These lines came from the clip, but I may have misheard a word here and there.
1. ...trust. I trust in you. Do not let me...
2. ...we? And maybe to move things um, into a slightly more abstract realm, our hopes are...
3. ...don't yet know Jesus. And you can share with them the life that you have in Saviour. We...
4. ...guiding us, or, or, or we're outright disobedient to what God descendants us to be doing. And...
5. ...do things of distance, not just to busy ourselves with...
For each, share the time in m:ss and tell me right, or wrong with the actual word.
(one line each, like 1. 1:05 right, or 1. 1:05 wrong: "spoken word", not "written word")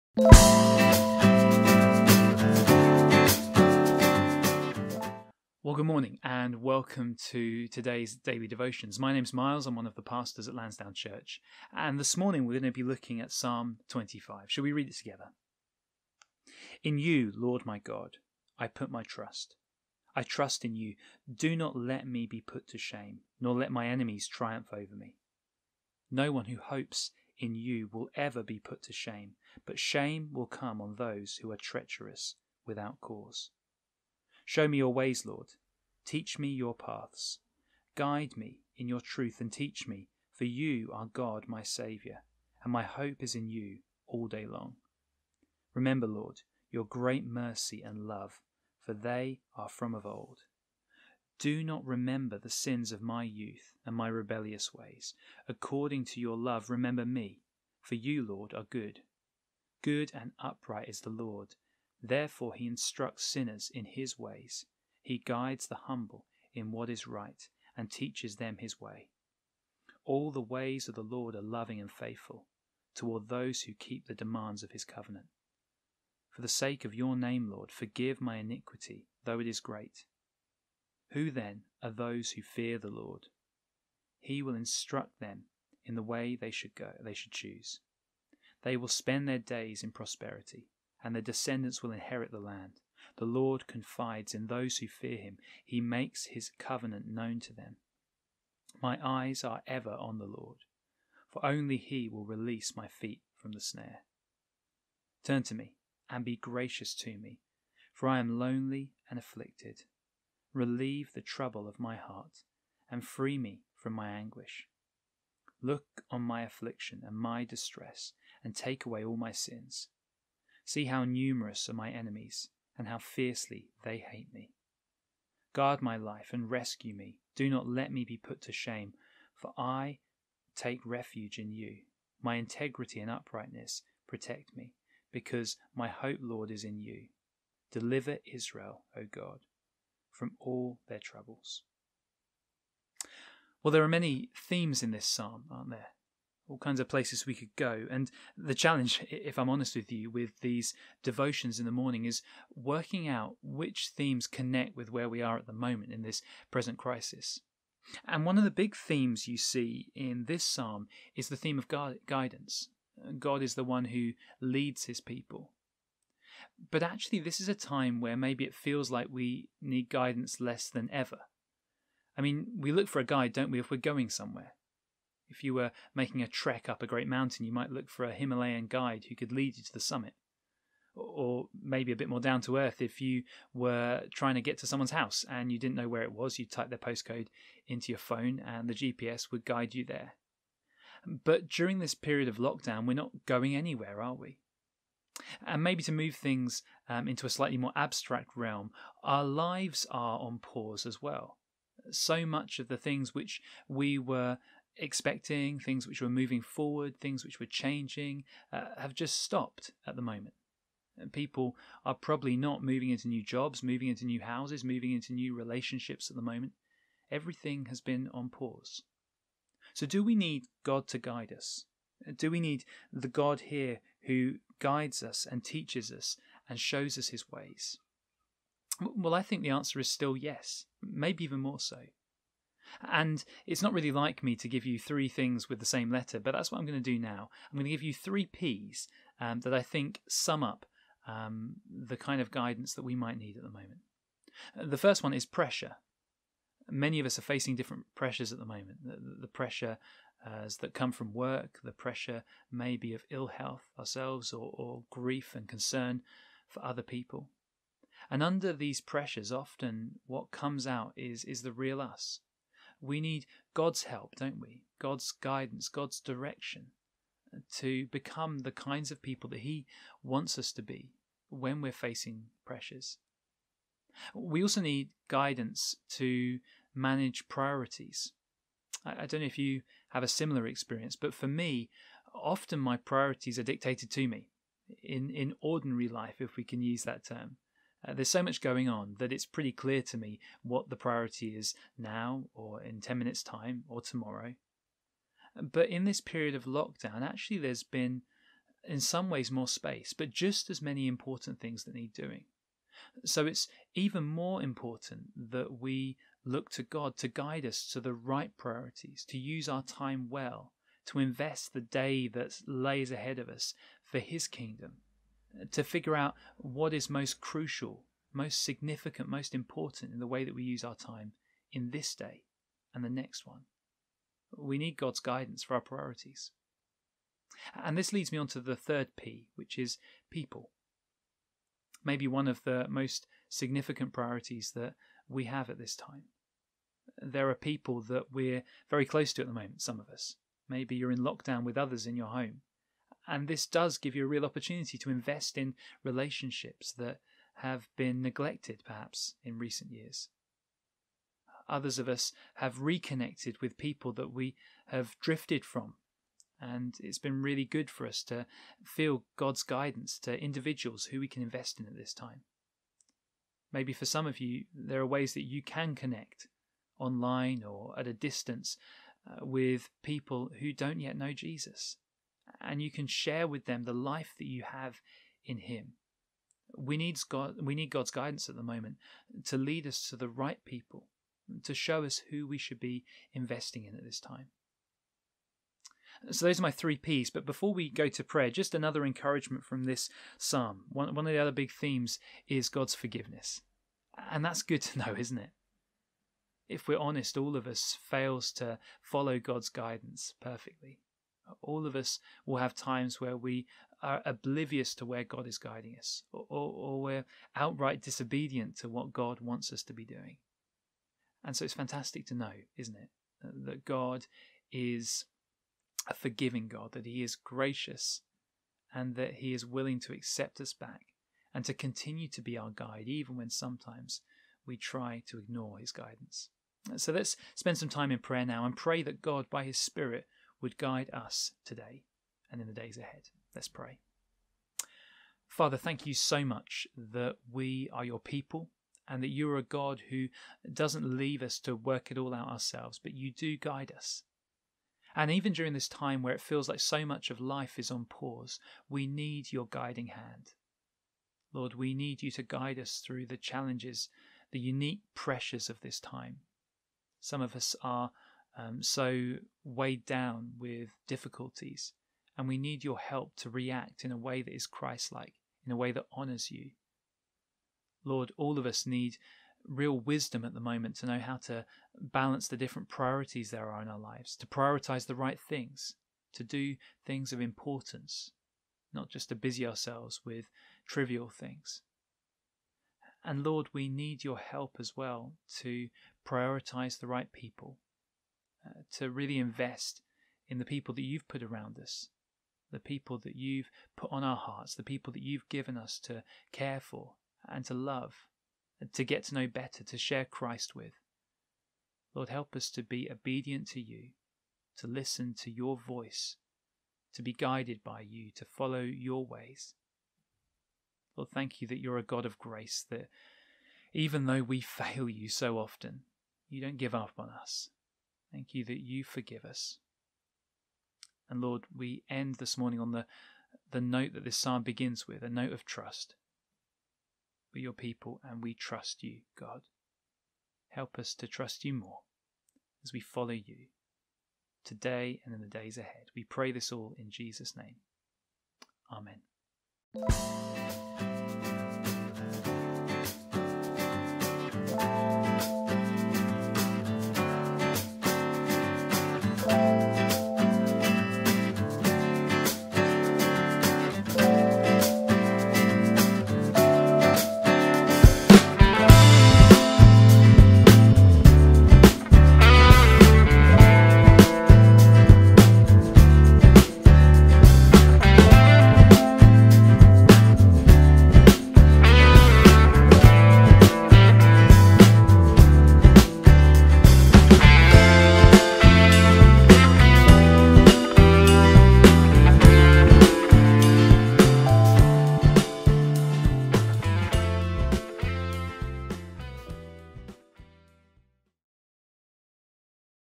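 1. 0:19 right
2. 3:14 wrong: "lives", not "hopes"
3. 6:10 wrong: "Him", not "Saviour"
4. 6:45 wrong: "wants", not "descendants"
5. 7:56 wrong: "importance", not "distance".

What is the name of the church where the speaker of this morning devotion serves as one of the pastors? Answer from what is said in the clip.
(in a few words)
Lansdowne Church.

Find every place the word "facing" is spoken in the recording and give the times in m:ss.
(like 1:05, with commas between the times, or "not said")
4:07, 4:31.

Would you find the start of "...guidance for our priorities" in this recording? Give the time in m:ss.
5:24.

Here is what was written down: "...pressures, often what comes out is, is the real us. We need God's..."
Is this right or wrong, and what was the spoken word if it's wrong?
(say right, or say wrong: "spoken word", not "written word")
right.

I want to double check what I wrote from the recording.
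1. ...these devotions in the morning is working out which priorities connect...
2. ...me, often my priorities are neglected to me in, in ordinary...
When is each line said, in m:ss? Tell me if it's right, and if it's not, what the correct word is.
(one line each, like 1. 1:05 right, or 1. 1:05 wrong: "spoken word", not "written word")
1. 2:30 wrong: "themes", not "priorities"
2. 4:41 wrong: "dictated", not "neglected".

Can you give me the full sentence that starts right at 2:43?
God is the one who leads his people.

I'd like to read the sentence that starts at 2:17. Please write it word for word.
Deliver Israel, O God, from all their troubles.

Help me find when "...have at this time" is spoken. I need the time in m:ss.
5:35.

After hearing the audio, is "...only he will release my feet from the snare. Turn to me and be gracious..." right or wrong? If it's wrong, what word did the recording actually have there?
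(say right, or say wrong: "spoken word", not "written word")
right.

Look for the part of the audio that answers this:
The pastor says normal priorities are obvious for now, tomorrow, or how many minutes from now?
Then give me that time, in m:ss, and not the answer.
4:52.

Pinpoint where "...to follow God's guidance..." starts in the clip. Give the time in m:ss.
6:38.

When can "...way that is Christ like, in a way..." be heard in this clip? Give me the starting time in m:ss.
7:43.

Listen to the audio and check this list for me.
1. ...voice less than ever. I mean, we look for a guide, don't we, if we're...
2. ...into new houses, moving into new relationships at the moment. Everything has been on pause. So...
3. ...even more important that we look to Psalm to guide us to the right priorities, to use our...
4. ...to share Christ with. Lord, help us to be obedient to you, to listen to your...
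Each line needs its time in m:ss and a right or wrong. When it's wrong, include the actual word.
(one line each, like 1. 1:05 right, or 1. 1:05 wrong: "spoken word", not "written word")
1. 2:49 wrong: "guidance", not "voice"
2. 3:33 right
3. 5:03 wrong: "God", not "Psalm"
4. 8:19 right.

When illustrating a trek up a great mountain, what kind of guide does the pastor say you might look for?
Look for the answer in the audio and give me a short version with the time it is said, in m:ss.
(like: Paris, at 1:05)
Himalayan guide, at 2:58.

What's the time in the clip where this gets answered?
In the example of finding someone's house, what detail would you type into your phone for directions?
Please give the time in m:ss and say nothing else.
3:06.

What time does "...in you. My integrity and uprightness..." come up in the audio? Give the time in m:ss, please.
2:11.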